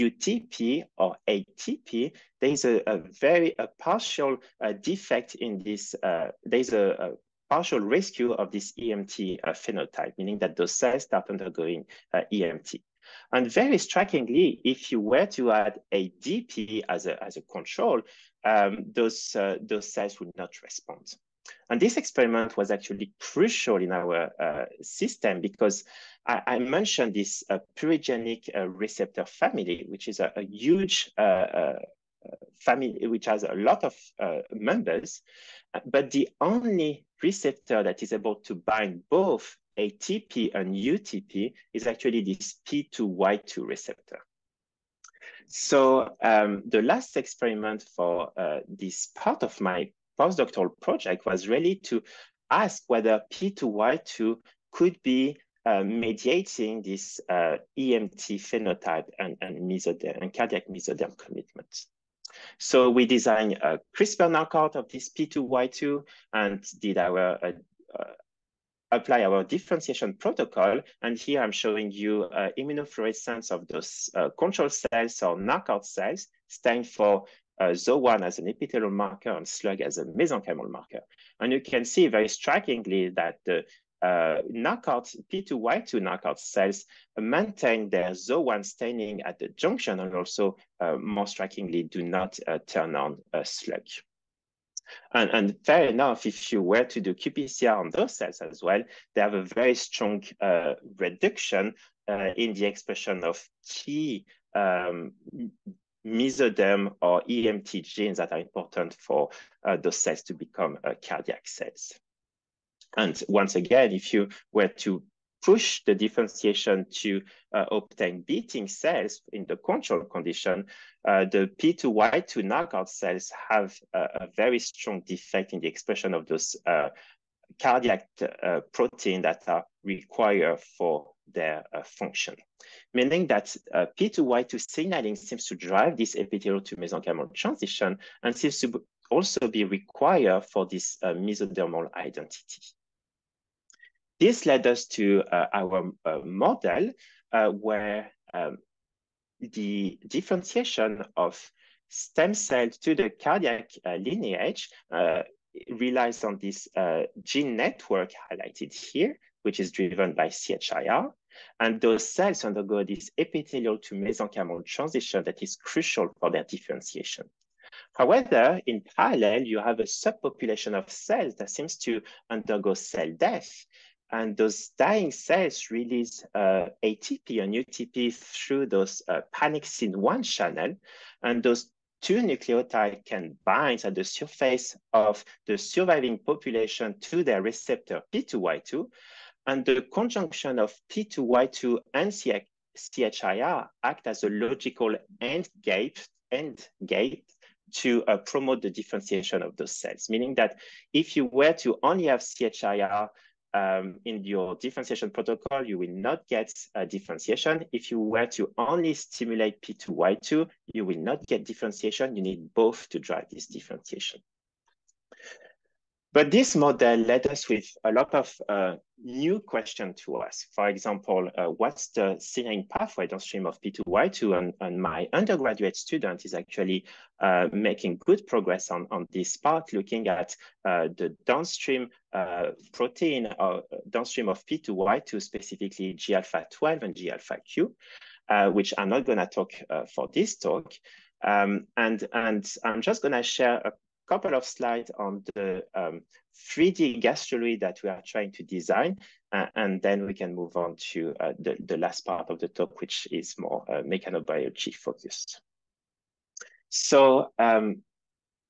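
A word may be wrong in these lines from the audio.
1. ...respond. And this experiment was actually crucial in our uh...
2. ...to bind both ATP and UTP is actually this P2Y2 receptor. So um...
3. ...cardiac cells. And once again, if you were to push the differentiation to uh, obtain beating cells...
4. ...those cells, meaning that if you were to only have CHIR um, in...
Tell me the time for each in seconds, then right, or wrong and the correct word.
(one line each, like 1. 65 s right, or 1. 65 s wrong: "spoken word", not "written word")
1. 20 s right
2. 38 s right
3. 111 s right
4. 199 s right.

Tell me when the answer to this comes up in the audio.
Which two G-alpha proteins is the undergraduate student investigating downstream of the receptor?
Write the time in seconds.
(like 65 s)
235 s.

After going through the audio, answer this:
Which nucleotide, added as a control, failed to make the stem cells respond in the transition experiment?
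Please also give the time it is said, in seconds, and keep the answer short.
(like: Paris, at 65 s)
ADP, at 15 s.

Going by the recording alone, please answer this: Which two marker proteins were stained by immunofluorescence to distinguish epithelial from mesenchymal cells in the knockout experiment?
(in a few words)
ZO1 and SLUG.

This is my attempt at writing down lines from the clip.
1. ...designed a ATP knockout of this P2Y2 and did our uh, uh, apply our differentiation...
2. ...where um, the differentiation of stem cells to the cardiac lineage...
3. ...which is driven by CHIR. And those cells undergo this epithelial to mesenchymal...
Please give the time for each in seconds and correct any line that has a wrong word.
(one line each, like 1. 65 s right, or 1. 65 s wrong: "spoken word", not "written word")
1. 63 s wrong: "CRISPR", not "ATP"
2. 147 s right
3. 159 s right.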